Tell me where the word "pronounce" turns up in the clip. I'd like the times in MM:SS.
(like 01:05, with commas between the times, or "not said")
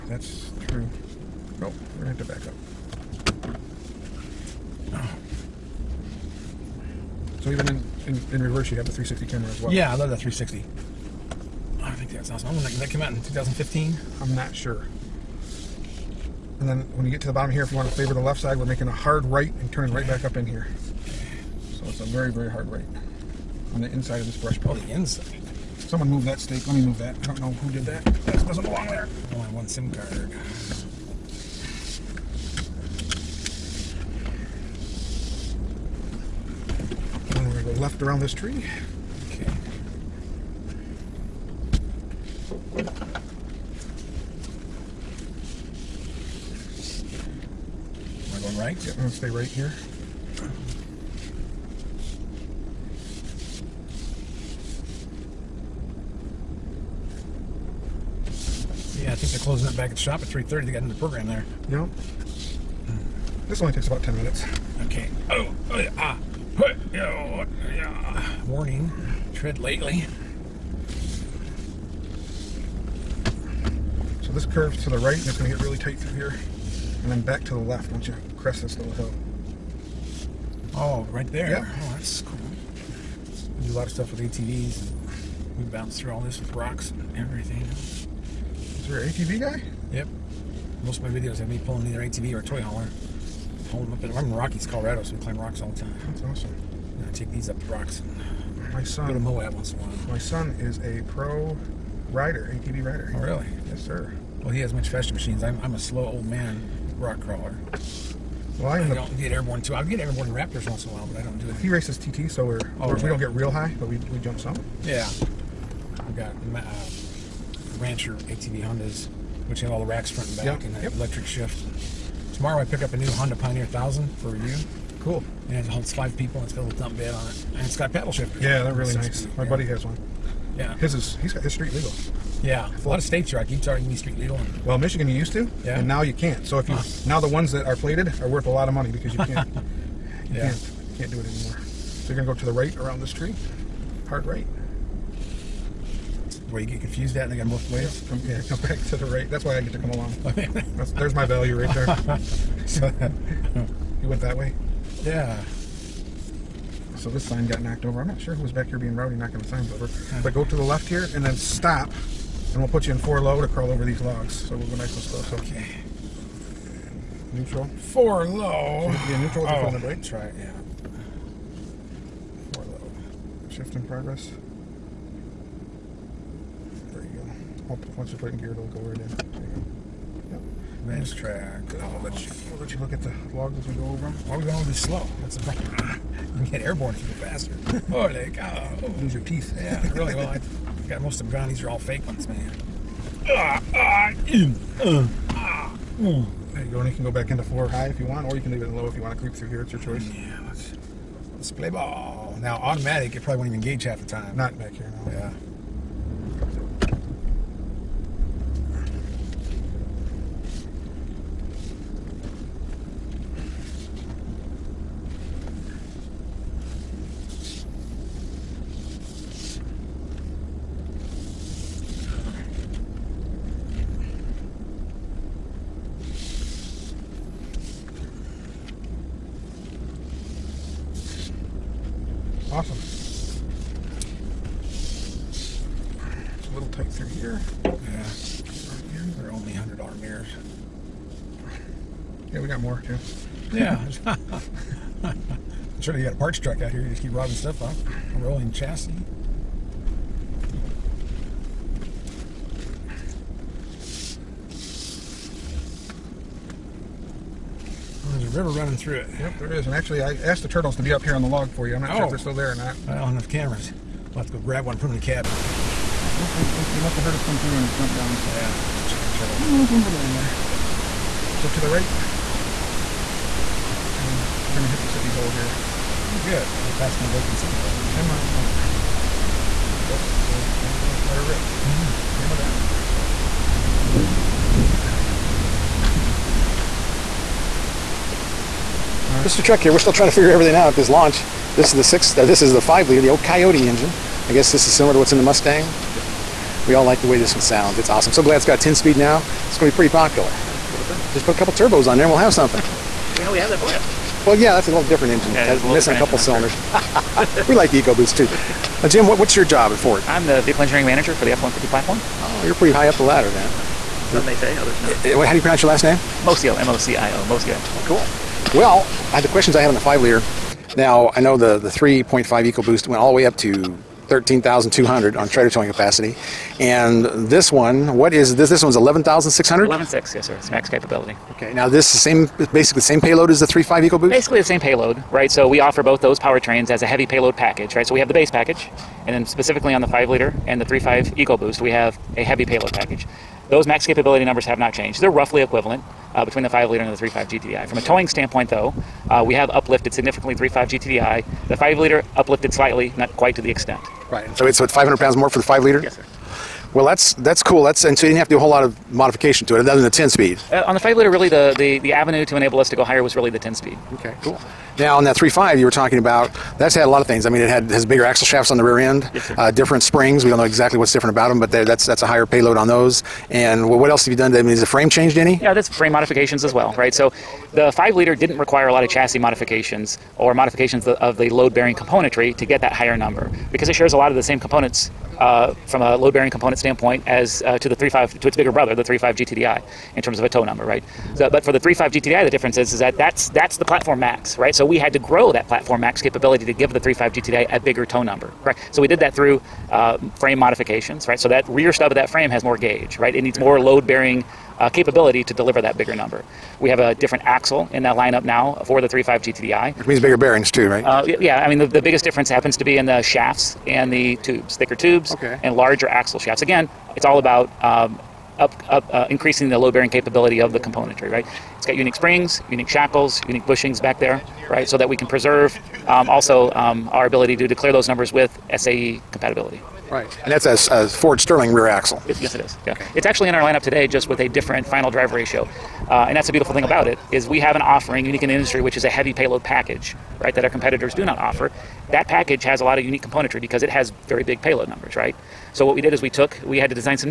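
05:15.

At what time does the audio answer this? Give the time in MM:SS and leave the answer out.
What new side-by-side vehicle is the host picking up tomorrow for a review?
02:03.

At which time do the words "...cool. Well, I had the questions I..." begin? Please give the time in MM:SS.
05:17.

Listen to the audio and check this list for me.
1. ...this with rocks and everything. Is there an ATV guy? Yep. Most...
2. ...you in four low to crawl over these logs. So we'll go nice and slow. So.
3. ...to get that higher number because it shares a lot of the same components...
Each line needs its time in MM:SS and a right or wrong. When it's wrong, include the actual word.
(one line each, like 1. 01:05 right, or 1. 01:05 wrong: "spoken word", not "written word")
1. 01:26 right
2. 02:42 right
3. 06:22 right.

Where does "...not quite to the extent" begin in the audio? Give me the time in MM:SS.
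05:52.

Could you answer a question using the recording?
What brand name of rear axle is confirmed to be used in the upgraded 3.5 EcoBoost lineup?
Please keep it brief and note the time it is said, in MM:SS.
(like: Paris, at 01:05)
Ford Sterling, at 07:10.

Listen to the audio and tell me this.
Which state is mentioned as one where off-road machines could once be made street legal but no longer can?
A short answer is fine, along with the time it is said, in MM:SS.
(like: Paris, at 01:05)
Michigan, at 02:14.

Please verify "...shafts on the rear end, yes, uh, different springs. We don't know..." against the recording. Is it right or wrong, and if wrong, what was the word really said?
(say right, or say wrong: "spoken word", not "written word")
right.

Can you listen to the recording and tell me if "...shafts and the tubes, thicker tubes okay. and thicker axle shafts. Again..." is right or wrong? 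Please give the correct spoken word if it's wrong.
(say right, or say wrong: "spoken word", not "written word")
wrong: "larger", not "thicker".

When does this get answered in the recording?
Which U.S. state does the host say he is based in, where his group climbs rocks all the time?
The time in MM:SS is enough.
01:34.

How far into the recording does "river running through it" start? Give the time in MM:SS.
04:18.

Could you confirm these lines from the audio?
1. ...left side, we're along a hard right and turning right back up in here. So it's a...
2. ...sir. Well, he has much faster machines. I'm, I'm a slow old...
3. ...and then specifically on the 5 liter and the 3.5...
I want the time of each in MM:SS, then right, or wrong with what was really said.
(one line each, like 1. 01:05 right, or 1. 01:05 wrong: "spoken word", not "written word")
1. 00:18 wrong: "making", not "along"
2. 01:43 right
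3. 05:39 right.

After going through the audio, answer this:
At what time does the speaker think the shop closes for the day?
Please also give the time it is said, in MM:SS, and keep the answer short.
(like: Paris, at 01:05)
3:30, at 01:00.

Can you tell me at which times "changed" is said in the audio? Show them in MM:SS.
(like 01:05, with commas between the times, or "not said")
05:44, 06:14.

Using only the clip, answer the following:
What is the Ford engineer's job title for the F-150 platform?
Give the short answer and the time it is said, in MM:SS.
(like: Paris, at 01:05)
Vehicle engineering manager, at 05:10.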